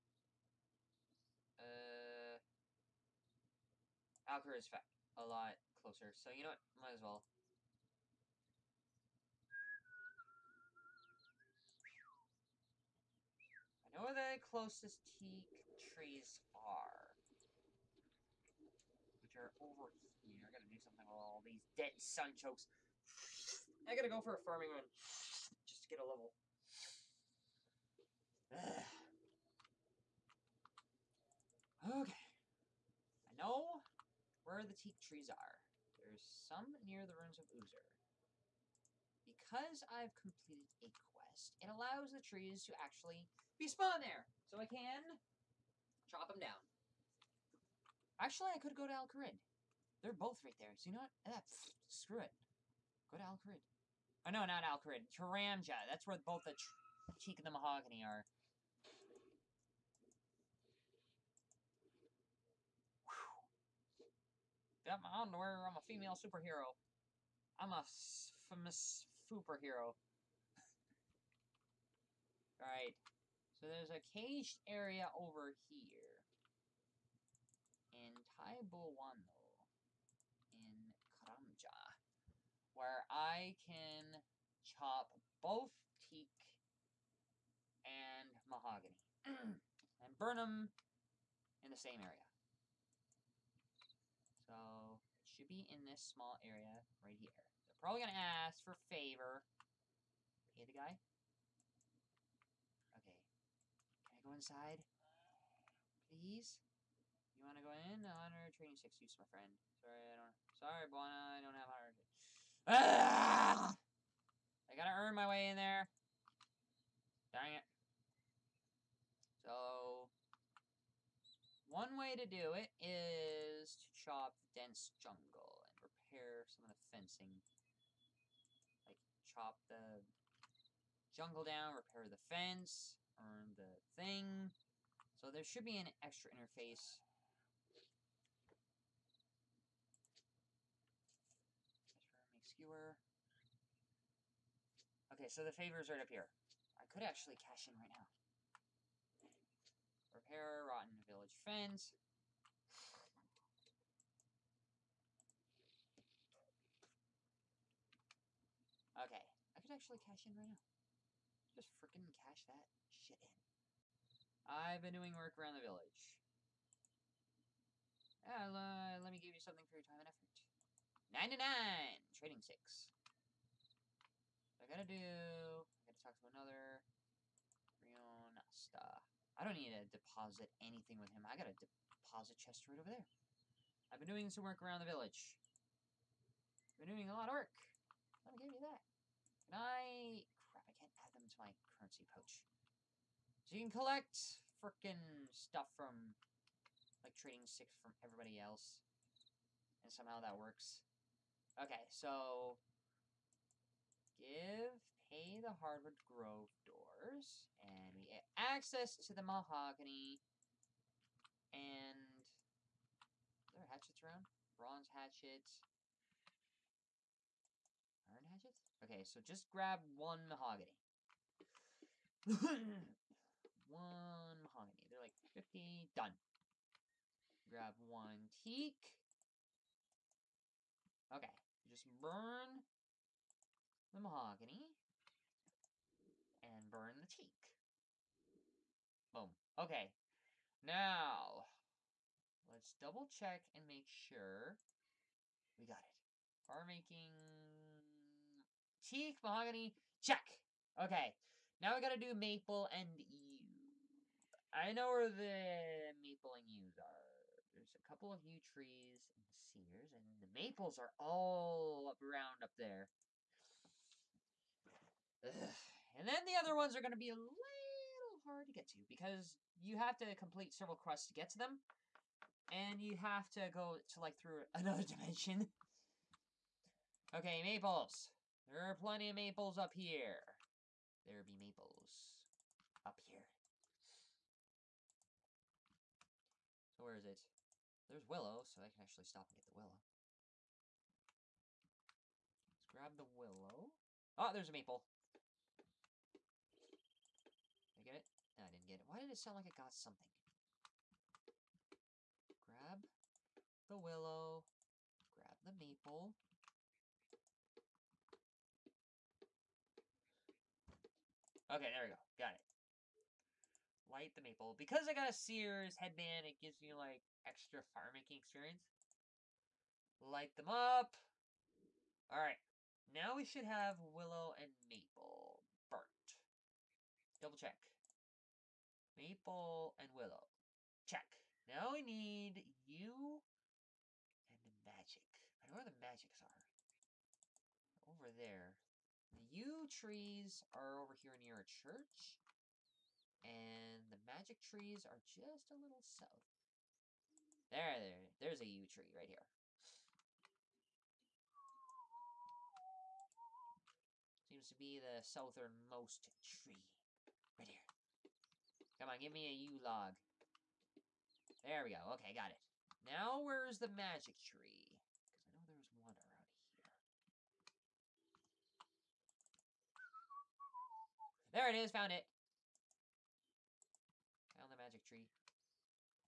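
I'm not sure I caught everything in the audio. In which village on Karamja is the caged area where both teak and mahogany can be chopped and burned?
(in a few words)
Taibowano.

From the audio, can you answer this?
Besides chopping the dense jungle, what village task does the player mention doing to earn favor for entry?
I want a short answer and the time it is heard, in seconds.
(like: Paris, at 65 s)
Repair the fence, at 131 s.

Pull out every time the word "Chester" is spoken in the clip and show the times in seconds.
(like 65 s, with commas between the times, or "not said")
182 s.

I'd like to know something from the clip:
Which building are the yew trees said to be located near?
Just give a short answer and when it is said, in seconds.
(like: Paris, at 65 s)
a church, at 341 s.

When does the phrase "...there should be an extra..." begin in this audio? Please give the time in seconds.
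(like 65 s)
135 s.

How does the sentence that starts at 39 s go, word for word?
Because I've completed a quest, it allows the trees to actually be spawned there.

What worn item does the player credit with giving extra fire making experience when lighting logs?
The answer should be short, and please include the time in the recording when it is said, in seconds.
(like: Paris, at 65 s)
Seers' headband, at 315 s.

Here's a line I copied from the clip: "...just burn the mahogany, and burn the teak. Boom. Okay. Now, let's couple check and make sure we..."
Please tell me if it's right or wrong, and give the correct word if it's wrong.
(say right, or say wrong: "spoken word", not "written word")
wrong: "double", not "couple".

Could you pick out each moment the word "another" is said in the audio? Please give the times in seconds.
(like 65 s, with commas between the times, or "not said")
176 s, 274 s.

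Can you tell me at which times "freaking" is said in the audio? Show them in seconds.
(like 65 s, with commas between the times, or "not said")
161 s, 194 s.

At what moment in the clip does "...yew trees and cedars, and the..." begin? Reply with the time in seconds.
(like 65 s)
258 s.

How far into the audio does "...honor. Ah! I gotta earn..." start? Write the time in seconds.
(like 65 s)
111 s.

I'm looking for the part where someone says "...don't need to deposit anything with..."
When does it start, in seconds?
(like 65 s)
179 s.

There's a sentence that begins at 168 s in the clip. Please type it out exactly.
Uh, let me give you something for your time and effort.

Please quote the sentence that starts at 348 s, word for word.
There's a yew tree right here.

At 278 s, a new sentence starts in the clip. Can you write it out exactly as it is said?
There are plenty of maples up here.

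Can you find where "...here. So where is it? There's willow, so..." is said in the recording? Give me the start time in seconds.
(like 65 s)
283 s.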